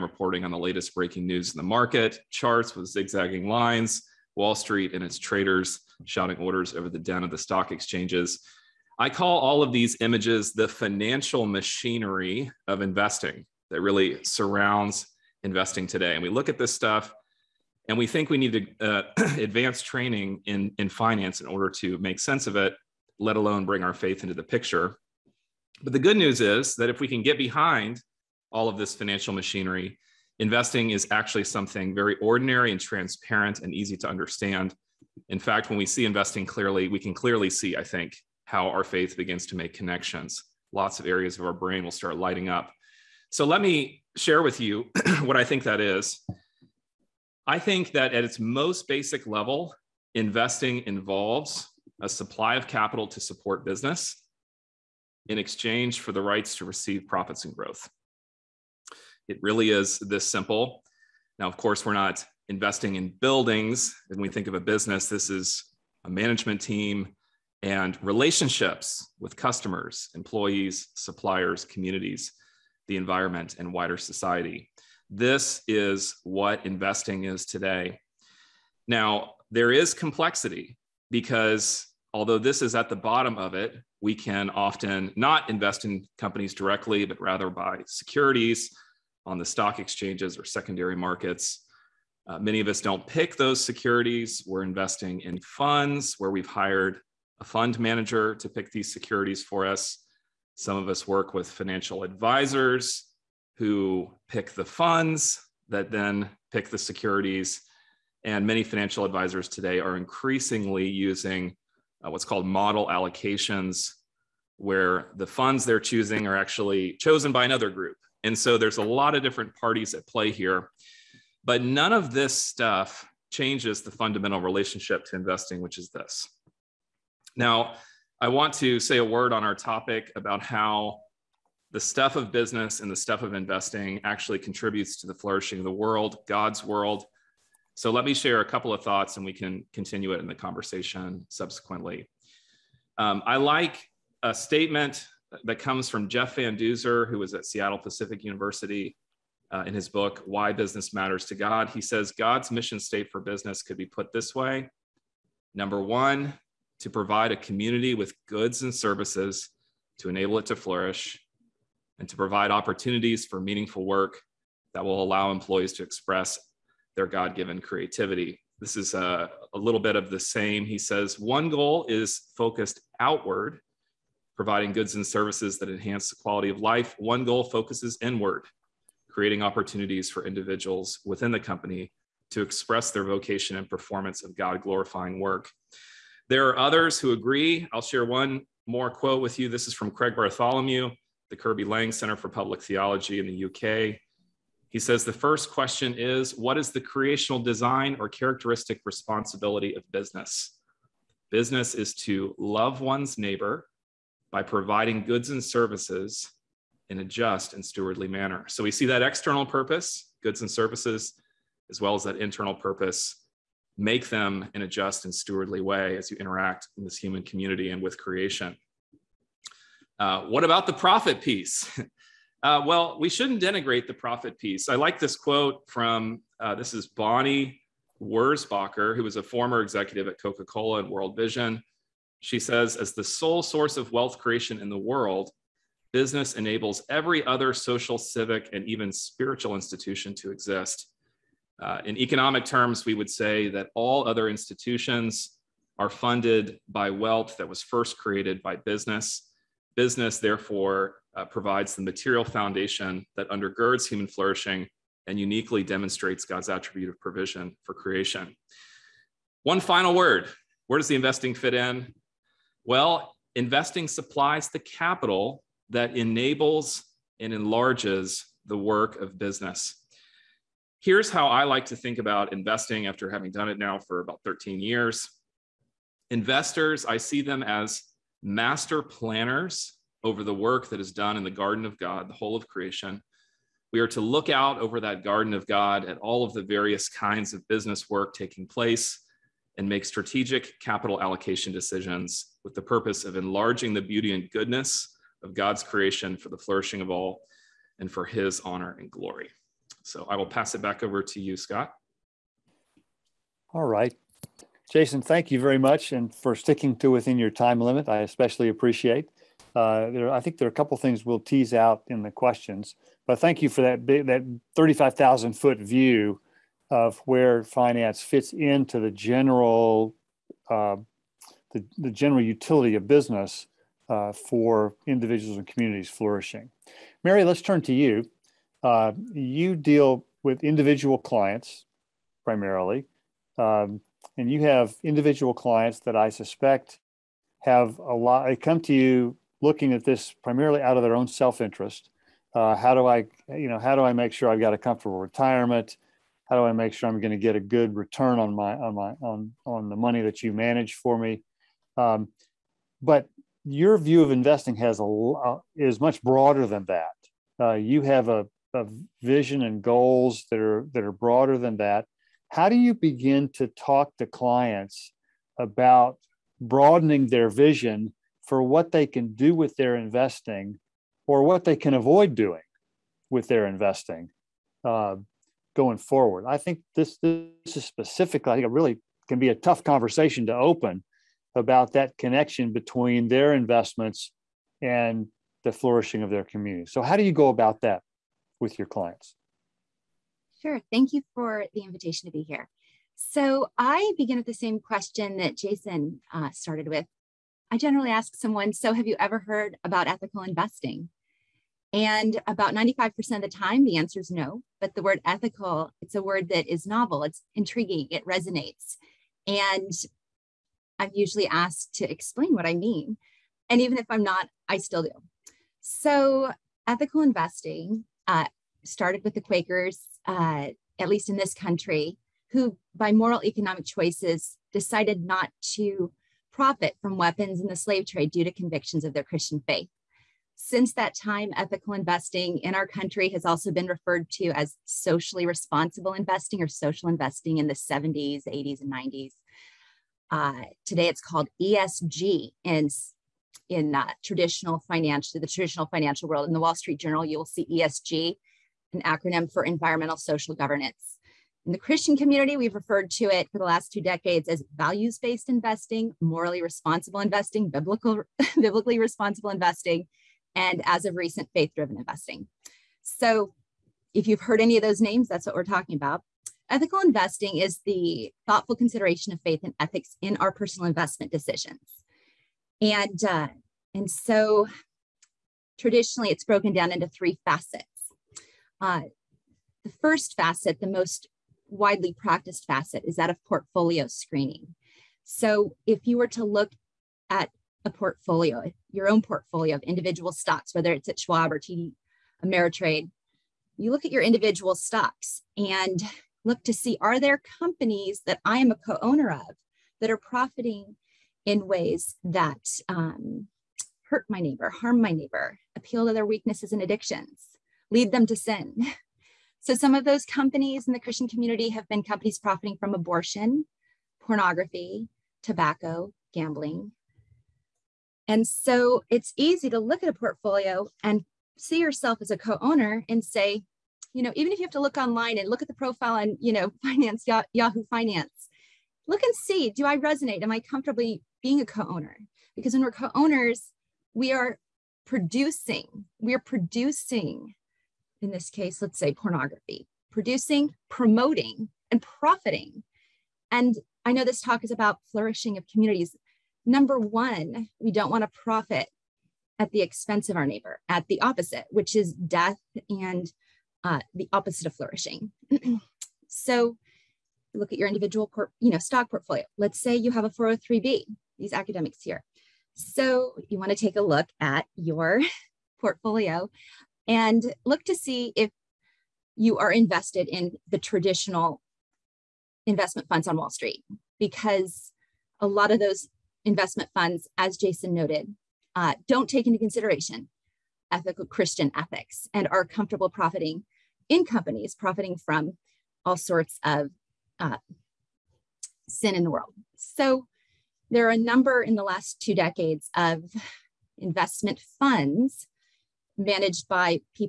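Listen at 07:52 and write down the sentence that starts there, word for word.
And, uh, and so traditionally it's broken down into three facets.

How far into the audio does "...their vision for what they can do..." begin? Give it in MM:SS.
06:07.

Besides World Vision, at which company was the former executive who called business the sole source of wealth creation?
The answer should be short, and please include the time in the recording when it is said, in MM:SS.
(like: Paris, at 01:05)
Coca Cola, at 03:50.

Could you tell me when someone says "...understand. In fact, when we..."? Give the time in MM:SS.
00:34.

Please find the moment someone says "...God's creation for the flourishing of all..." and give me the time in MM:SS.
04:55.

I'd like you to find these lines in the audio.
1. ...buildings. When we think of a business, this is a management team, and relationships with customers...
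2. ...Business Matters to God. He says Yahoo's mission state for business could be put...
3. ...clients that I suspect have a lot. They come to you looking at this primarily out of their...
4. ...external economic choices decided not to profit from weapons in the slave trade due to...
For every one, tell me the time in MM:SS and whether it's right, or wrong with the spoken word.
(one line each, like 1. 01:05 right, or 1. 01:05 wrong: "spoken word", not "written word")
1. 01:03 right
2. 02:30 wrong: "God", not "Yahoo"
3. 05:35 right
4. 07:02 wrong: "moral", not "external".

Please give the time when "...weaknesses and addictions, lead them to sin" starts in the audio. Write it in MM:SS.
08:26.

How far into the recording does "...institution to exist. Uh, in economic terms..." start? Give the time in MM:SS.
03:59.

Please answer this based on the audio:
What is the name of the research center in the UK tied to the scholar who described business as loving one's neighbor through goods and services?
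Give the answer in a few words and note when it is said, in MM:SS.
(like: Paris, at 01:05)
Kirby Laing Center, at 03:11.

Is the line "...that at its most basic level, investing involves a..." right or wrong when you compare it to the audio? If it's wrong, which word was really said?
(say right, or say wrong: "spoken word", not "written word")
right.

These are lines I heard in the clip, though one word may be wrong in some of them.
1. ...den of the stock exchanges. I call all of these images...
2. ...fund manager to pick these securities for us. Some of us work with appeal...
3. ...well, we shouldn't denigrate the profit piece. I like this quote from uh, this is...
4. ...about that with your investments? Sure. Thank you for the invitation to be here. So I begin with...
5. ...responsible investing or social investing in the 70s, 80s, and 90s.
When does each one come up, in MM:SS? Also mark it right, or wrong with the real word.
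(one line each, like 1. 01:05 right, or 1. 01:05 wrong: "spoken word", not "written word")
1. 00:06 right
2. 01:37 wrong: "financial", not "appeal"
3. 03:42 right
4. 06:27 wrong: "clients", not "investments"
5. 07:15 right.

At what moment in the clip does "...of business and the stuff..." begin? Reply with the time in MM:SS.
02:12.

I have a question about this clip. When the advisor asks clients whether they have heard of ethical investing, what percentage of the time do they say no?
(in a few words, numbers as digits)
95%.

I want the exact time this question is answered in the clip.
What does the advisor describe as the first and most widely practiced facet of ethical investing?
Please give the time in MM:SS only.
08:03.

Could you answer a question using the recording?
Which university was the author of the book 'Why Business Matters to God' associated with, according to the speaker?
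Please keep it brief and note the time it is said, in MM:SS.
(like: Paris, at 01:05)
Seattle Pacific University, at 02:27.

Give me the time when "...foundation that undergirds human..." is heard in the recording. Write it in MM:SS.
04:12.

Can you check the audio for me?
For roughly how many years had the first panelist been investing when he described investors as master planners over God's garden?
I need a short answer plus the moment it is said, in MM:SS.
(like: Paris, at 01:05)
13, at 04:34.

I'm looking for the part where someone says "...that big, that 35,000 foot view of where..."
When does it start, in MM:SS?
05:13.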